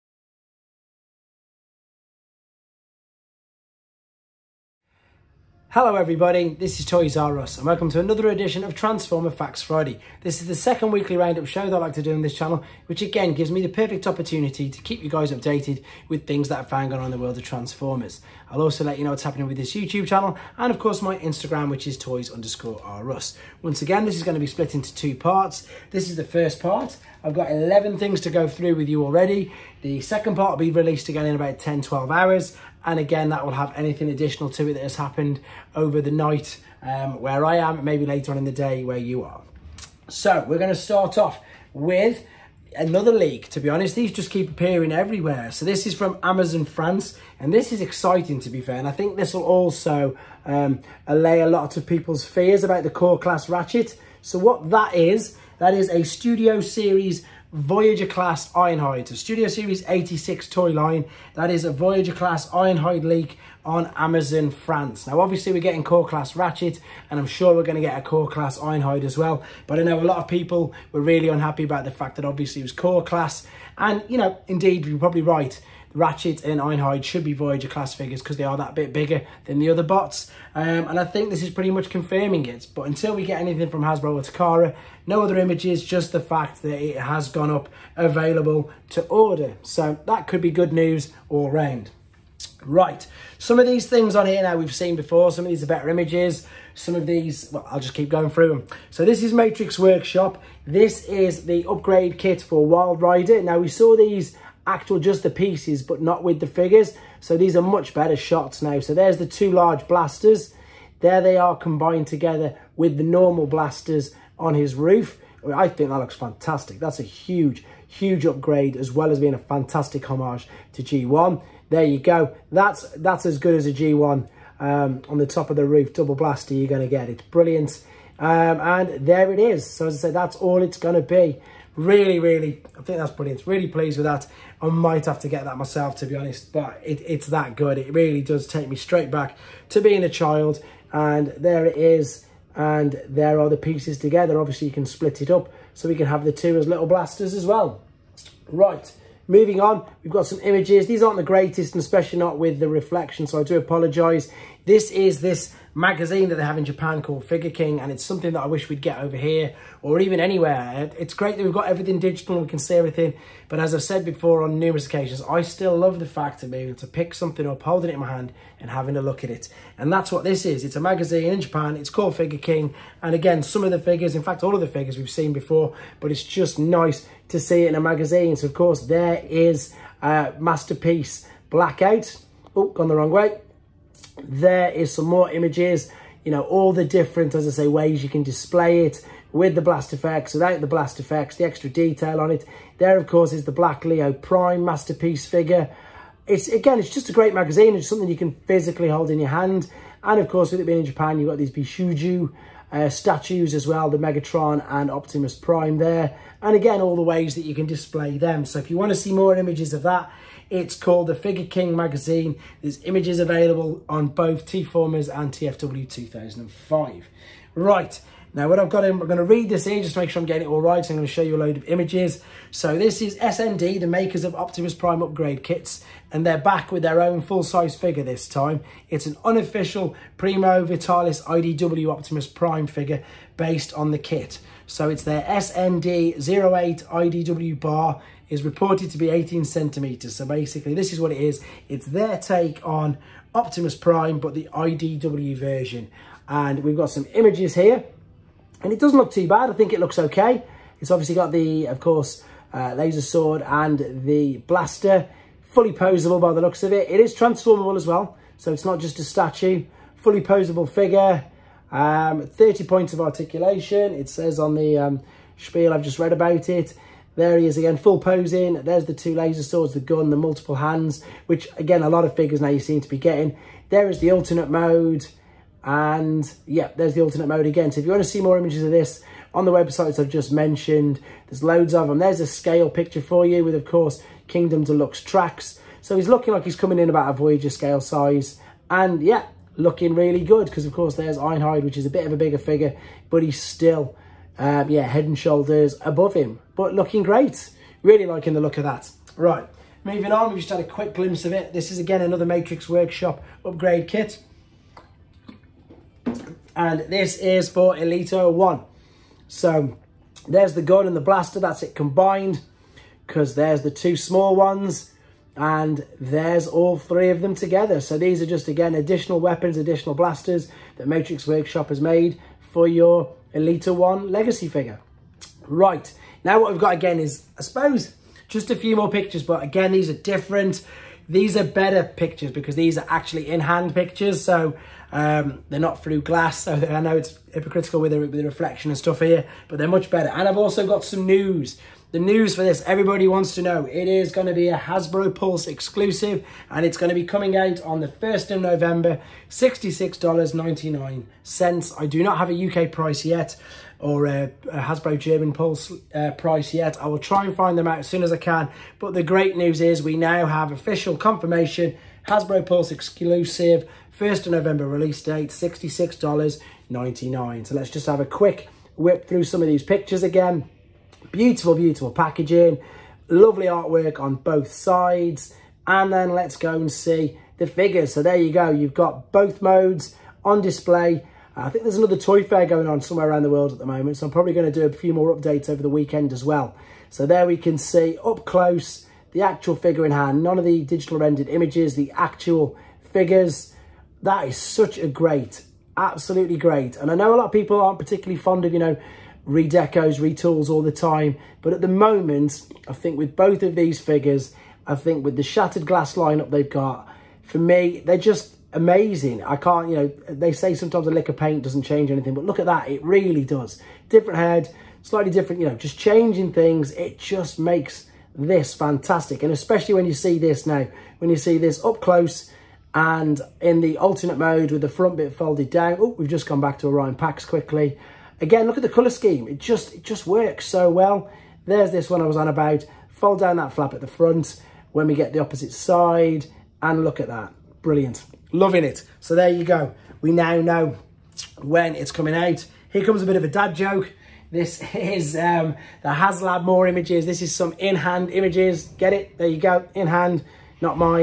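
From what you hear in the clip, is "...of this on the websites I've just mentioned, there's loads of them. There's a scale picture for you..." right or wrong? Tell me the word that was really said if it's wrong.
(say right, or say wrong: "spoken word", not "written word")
right.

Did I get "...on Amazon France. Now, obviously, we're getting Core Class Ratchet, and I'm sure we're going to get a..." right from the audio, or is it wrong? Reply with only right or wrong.
right.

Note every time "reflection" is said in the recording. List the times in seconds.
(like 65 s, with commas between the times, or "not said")
152 s, 338 s.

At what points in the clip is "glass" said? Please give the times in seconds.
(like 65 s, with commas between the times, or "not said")
336 s, 405 s.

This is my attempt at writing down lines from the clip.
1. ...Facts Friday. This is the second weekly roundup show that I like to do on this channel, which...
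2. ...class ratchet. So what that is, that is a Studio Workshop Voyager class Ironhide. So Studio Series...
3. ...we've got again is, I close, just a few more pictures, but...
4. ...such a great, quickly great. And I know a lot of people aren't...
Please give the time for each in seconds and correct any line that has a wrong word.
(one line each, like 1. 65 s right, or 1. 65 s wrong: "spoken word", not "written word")
1. 9 s right
2. 53 s wrong: "Series", not "Workshop"
3. 326 s wrong: "suppose", not "close"
4. 394 s wrong: "absolutely", not "quickly".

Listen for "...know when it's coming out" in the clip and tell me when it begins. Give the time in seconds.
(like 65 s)
440 s.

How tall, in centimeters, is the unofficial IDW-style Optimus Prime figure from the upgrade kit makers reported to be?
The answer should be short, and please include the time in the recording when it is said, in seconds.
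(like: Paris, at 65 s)
18, at 239 s.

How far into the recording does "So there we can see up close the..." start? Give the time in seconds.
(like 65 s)
386 s.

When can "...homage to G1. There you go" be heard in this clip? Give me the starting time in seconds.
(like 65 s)
120 s.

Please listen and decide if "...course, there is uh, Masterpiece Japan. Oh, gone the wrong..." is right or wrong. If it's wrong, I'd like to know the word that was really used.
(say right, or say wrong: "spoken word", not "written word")
wrong: "Blackout", not "Japan".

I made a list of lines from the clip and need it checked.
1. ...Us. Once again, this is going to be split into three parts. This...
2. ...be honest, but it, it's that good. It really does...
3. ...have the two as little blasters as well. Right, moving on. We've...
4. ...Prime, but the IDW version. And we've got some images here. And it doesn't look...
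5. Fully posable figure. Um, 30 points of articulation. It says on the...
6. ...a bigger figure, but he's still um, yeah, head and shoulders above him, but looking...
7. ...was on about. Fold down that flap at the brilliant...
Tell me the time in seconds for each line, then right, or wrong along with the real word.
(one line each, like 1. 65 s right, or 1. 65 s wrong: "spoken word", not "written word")
1. 23 s wrong: "two", not "three"
2. 136 s right
3. 146 s right
4. 243 s right
5. 259 s right
6. 292 s right
7. 432 s wrong: "front", not "brilliant".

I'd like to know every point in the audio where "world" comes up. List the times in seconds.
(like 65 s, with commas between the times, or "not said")
17 s, 383 s.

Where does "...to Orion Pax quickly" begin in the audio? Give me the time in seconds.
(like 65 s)
426 s.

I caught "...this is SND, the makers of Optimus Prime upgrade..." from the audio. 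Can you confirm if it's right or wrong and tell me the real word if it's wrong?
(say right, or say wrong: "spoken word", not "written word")
right.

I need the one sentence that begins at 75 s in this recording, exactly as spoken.
Ratchet and Ironhide should be Voyager class figures because they are that bit bigger than the other bots.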